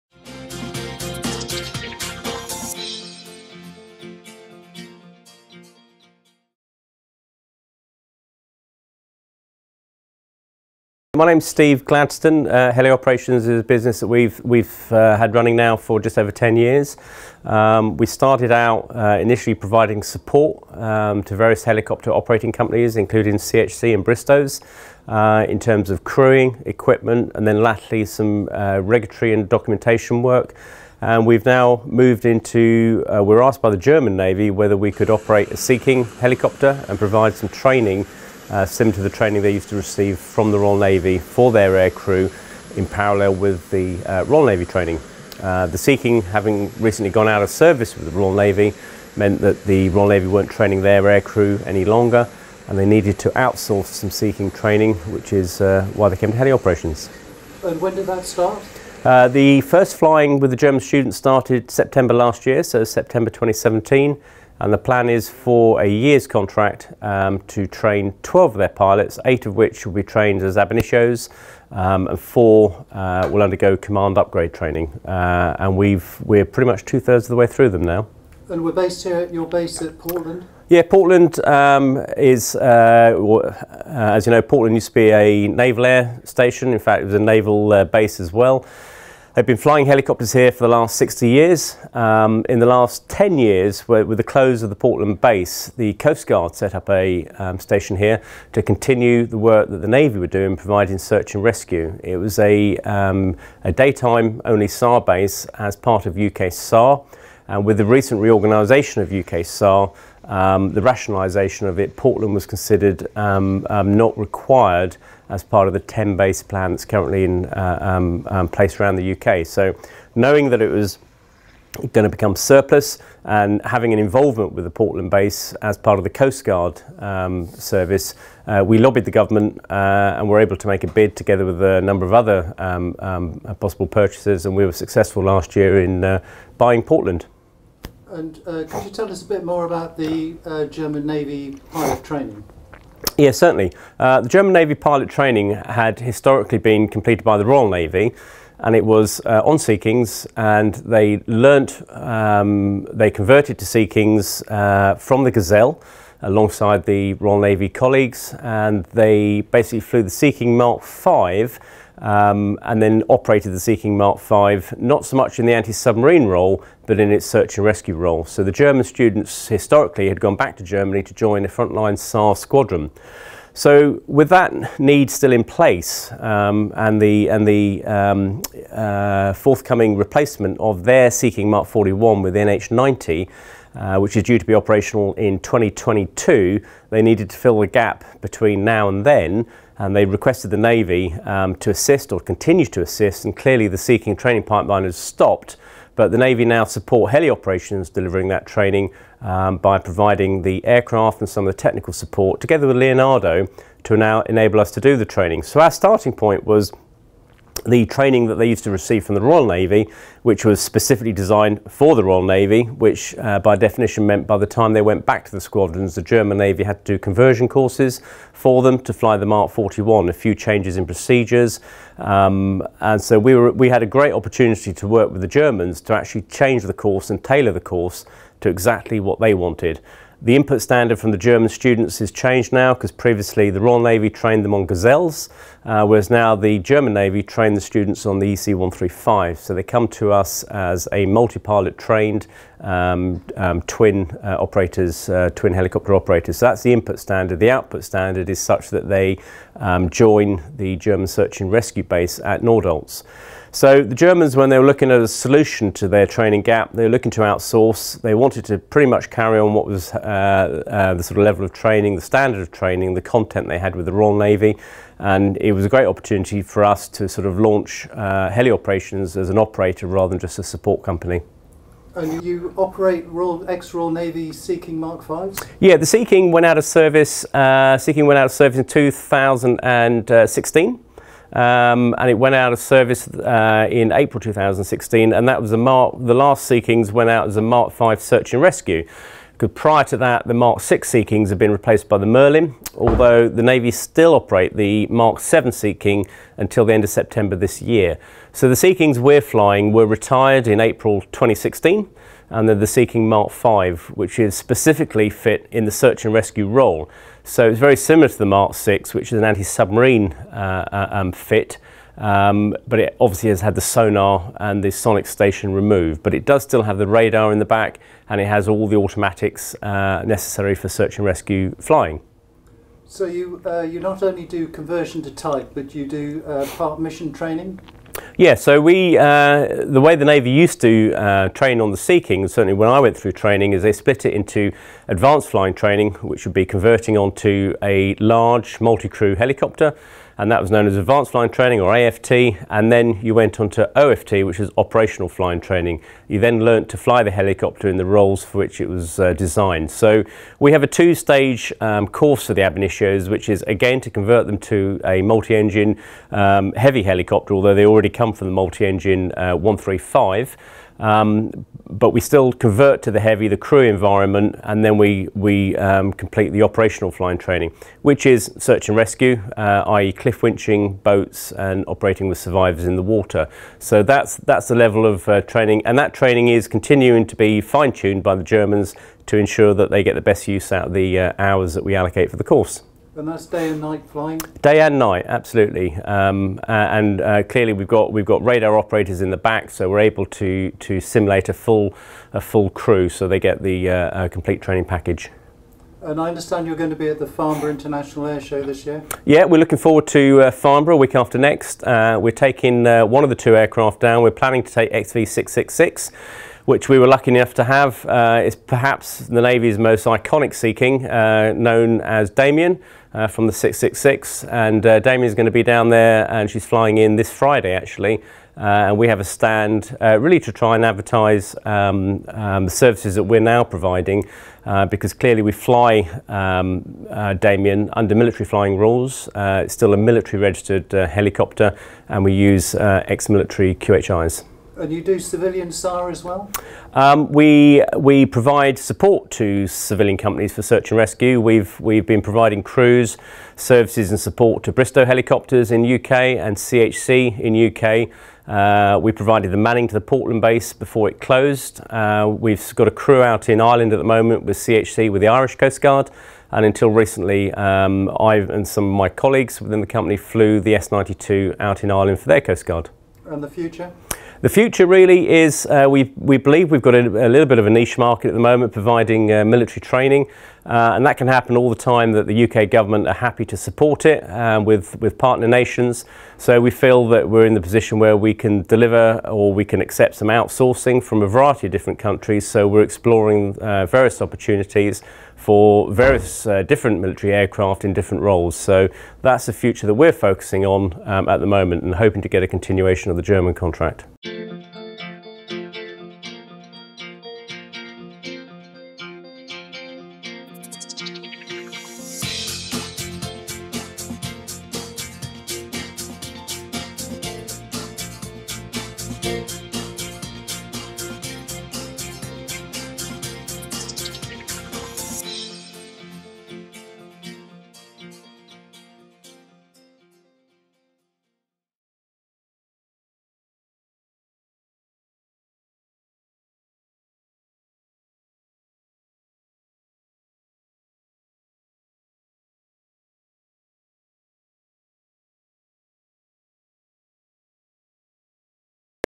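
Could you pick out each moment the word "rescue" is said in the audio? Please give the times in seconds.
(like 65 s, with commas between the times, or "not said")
101 s, 167 s, 251 s, 288 s, 306 s, 321 s, 368 s, 440 s.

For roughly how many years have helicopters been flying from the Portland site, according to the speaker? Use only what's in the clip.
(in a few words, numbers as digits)
60 years.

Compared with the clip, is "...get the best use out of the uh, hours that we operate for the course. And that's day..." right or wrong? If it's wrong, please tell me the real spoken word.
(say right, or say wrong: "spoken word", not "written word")
wrong: "allocate", not "operate".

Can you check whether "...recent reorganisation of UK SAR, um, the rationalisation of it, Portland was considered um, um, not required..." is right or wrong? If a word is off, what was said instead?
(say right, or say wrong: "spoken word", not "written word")
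right.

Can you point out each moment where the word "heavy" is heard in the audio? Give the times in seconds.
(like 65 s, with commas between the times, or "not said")
356 s, 362 s.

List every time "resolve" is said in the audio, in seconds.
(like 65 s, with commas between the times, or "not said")
not said.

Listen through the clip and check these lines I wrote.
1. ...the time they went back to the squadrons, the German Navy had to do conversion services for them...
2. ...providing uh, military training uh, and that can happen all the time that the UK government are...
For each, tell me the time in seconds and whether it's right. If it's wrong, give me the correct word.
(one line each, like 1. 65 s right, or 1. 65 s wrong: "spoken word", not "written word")
1. 214 s wrong: "courses", not "services"
2. 468 s right.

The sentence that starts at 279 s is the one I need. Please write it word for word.
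Uh, um, and it went out of service uh, in April 2016, and that was a Mark.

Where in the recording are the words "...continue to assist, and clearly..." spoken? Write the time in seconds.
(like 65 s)
192 s.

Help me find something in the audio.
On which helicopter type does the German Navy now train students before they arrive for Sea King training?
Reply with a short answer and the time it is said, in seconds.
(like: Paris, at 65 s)
EC-135, at 238 s.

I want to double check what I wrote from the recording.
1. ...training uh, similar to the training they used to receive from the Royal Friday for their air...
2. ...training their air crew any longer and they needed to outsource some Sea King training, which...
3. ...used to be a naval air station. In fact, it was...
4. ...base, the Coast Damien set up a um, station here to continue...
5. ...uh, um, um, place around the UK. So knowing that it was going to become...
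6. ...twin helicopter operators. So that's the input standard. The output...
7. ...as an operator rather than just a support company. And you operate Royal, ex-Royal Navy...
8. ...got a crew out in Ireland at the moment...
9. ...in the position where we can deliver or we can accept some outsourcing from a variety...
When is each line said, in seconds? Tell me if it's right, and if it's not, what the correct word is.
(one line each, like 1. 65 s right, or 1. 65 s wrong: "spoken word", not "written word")
1. 37 s wrong: "Navy", not "Friday"
2. 50 s right
3. 84 s right
4. 95 s wrong: "Guard", not "Damien"
5. 117 s right
6. 245 s right
7. 269 s right
8. 452 s right
9. 477 s right.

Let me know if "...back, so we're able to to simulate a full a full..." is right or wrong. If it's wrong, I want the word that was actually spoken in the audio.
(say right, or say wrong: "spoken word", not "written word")
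right.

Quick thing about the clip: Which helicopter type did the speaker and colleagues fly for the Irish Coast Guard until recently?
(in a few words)
S-92.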